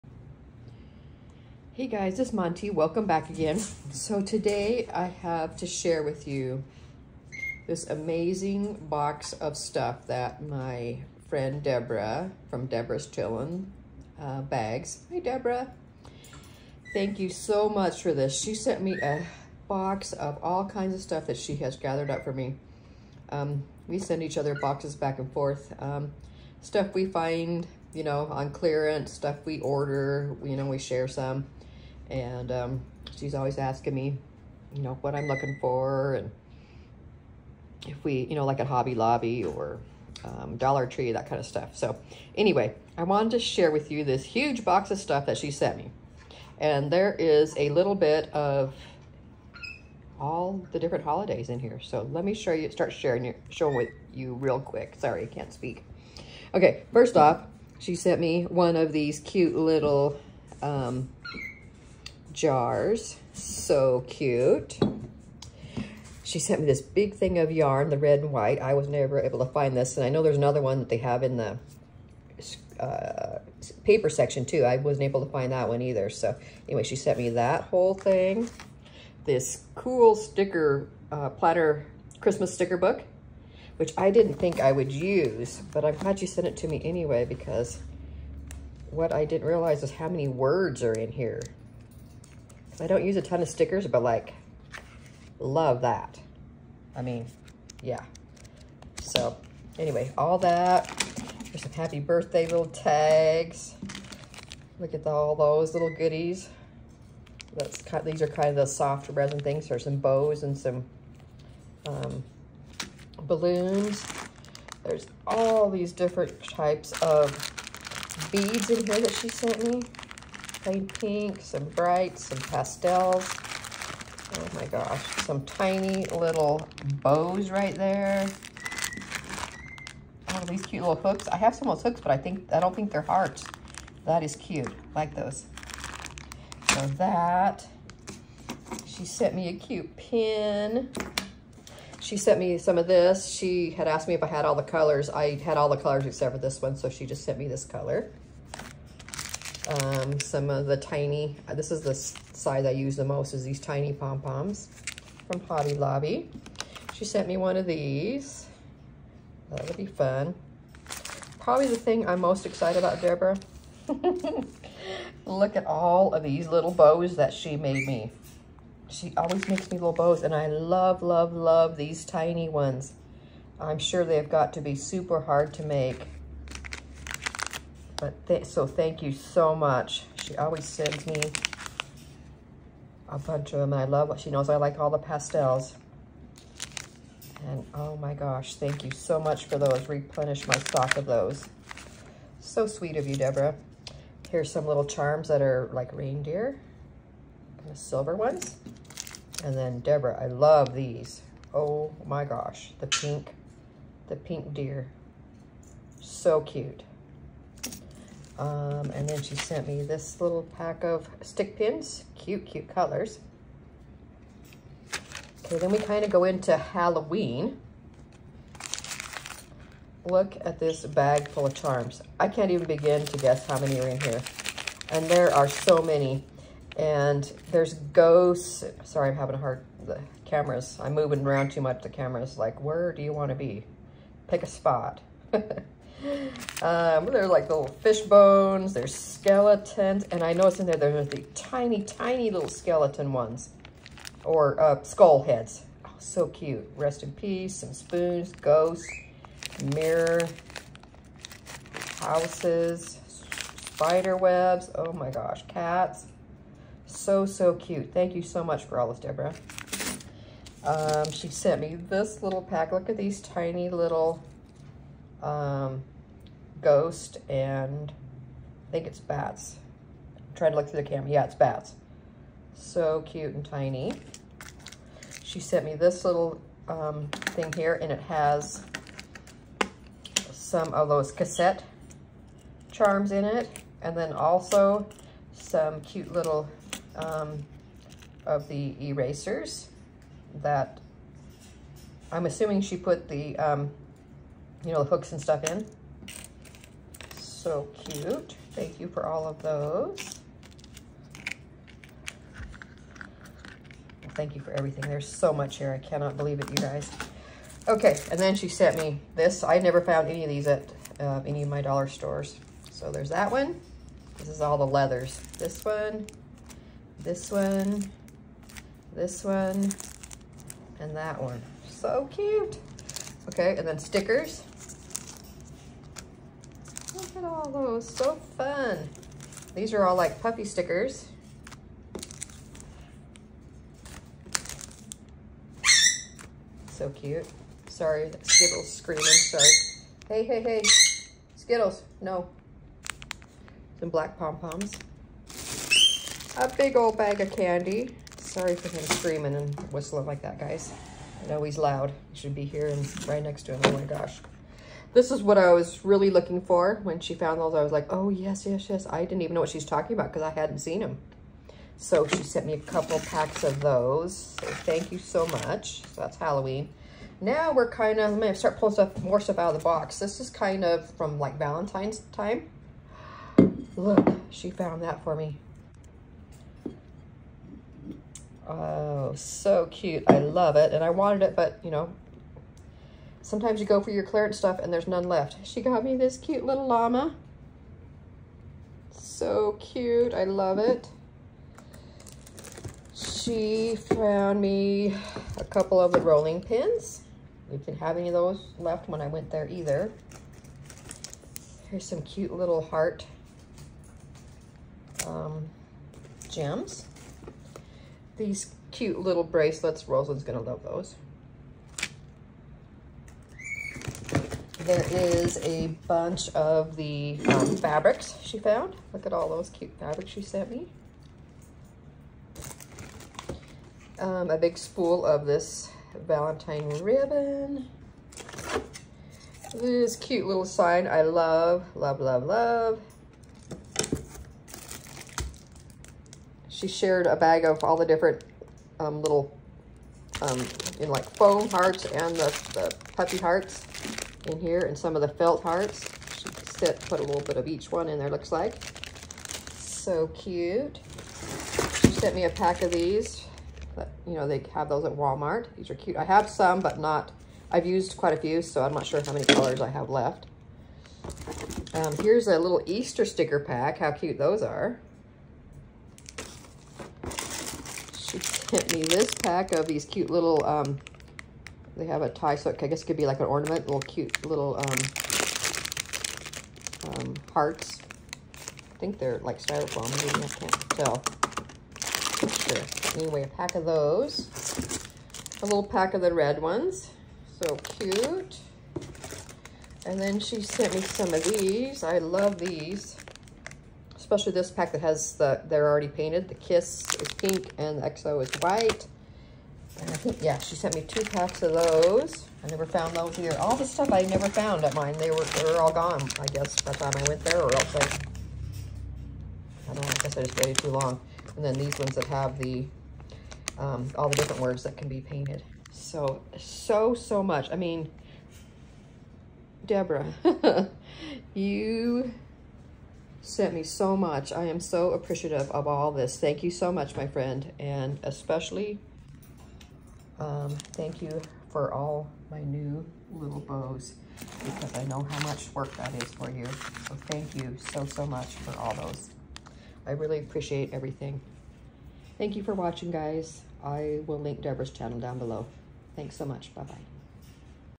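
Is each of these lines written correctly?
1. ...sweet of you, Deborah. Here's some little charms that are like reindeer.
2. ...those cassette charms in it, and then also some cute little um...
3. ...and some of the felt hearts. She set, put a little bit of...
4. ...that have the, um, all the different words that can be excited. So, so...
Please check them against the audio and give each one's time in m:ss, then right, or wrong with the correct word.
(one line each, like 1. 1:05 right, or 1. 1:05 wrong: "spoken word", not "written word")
1. 3:12 right
2. 4:40 right
3. 7:24 right
4. 8:31 wrong: "painted", not "excited".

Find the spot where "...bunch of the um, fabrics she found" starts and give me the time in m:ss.
6:55.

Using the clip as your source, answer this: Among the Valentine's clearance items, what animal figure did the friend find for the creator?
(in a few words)
llama.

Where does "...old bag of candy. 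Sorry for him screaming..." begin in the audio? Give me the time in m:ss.
5:46.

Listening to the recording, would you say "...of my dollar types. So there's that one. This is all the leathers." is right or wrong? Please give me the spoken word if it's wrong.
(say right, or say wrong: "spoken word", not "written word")
wrong: "stores", not "types".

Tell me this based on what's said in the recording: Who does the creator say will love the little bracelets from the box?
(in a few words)
Rosalind.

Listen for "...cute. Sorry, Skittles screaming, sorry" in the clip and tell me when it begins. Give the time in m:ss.
5:36.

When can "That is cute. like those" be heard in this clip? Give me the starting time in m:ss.
2:14.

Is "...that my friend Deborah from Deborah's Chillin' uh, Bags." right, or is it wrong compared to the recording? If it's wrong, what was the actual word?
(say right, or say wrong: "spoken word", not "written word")
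right.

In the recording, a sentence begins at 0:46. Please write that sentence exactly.
And there is a little bit of all the different holidays in here.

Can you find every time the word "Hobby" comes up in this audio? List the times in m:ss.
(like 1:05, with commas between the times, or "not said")
0:38, 2:35.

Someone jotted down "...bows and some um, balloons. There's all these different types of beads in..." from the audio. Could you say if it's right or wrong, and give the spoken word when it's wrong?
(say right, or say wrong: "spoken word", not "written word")
right.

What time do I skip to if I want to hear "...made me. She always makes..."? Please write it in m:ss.
2:47.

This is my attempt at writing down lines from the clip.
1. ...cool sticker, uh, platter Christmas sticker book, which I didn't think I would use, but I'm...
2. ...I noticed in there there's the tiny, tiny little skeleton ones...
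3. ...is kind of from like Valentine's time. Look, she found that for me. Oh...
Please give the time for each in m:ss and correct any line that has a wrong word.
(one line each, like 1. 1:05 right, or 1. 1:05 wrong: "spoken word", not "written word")
1. 1:19 right
2. 4:00 right
3. 6:10 right.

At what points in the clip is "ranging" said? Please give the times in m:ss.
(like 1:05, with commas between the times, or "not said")
not said.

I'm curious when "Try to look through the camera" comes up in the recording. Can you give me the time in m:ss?
4:30.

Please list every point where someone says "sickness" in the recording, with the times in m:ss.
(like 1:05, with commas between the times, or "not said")
not said.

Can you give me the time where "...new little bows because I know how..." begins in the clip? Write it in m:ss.
8:52.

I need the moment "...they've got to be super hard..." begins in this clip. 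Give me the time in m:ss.
2:54.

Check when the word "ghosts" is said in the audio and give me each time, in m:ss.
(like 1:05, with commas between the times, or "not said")
3:47, 4:08, 4:26.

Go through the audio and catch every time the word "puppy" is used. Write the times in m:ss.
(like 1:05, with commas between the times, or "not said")
5:30, 7:22.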